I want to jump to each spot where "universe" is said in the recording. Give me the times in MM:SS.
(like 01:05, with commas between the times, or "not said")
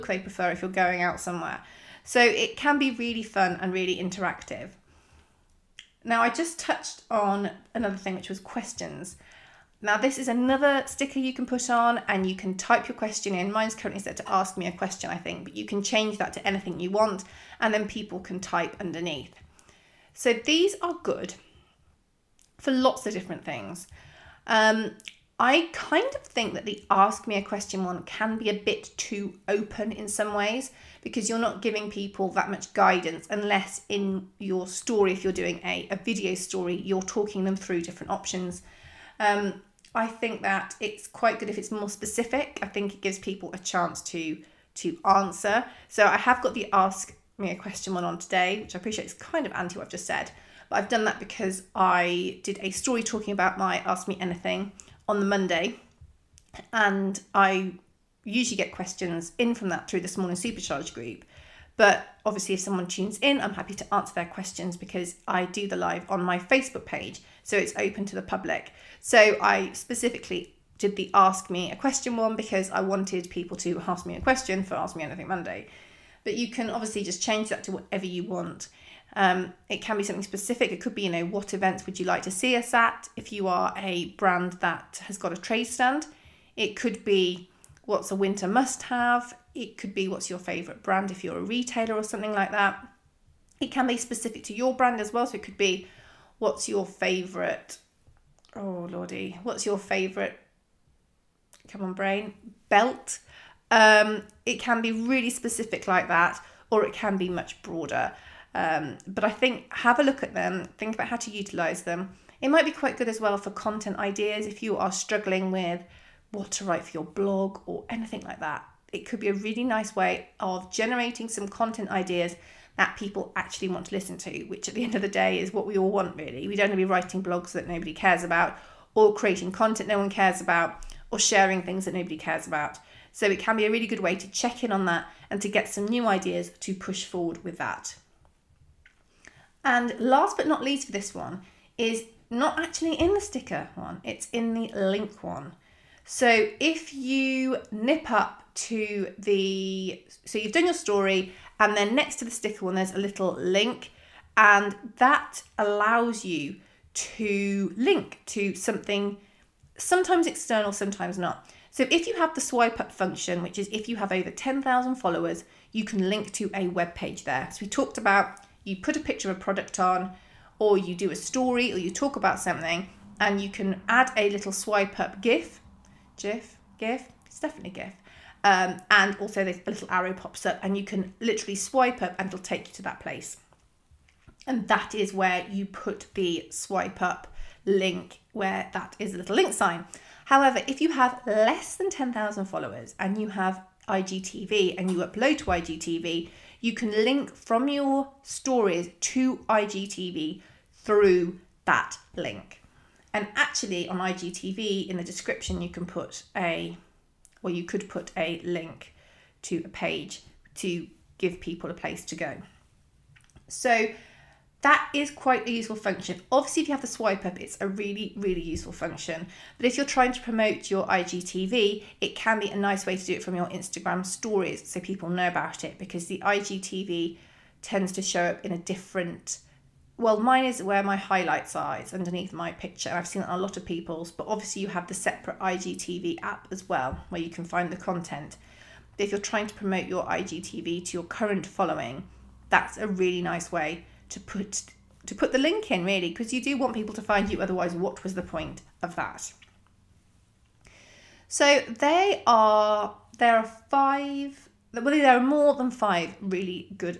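not said.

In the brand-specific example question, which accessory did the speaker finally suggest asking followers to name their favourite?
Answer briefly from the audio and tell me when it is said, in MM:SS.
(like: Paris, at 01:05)
belt, at 01:42.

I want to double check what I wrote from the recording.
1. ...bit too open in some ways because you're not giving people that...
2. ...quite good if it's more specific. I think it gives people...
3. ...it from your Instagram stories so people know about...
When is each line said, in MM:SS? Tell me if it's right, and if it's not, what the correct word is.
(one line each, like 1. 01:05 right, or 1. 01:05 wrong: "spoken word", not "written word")
1. 00:28 right
2. 00:41 right
3. 03:43 right.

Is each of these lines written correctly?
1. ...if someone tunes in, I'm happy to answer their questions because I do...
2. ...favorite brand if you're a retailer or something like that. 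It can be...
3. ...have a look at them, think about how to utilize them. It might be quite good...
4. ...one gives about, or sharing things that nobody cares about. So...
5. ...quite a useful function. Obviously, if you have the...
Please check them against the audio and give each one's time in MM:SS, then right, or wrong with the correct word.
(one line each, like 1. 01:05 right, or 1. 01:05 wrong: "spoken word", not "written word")
1. 01:02 right
2. 01:30 right
3. 01:49 right
4. 02:09 wrong: "cares", not "gives"
5. 03:35 right.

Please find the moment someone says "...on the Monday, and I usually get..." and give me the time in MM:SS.
00:55.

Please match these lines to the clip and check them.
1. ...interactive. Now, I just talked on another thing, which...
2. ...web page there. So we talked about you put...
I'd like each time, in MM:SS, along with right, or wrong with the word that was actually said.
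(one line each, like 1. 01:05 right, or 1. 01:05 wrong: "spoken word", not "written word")
1. 00:03 wrong: "touched", not "talked"
2. 02:46 right.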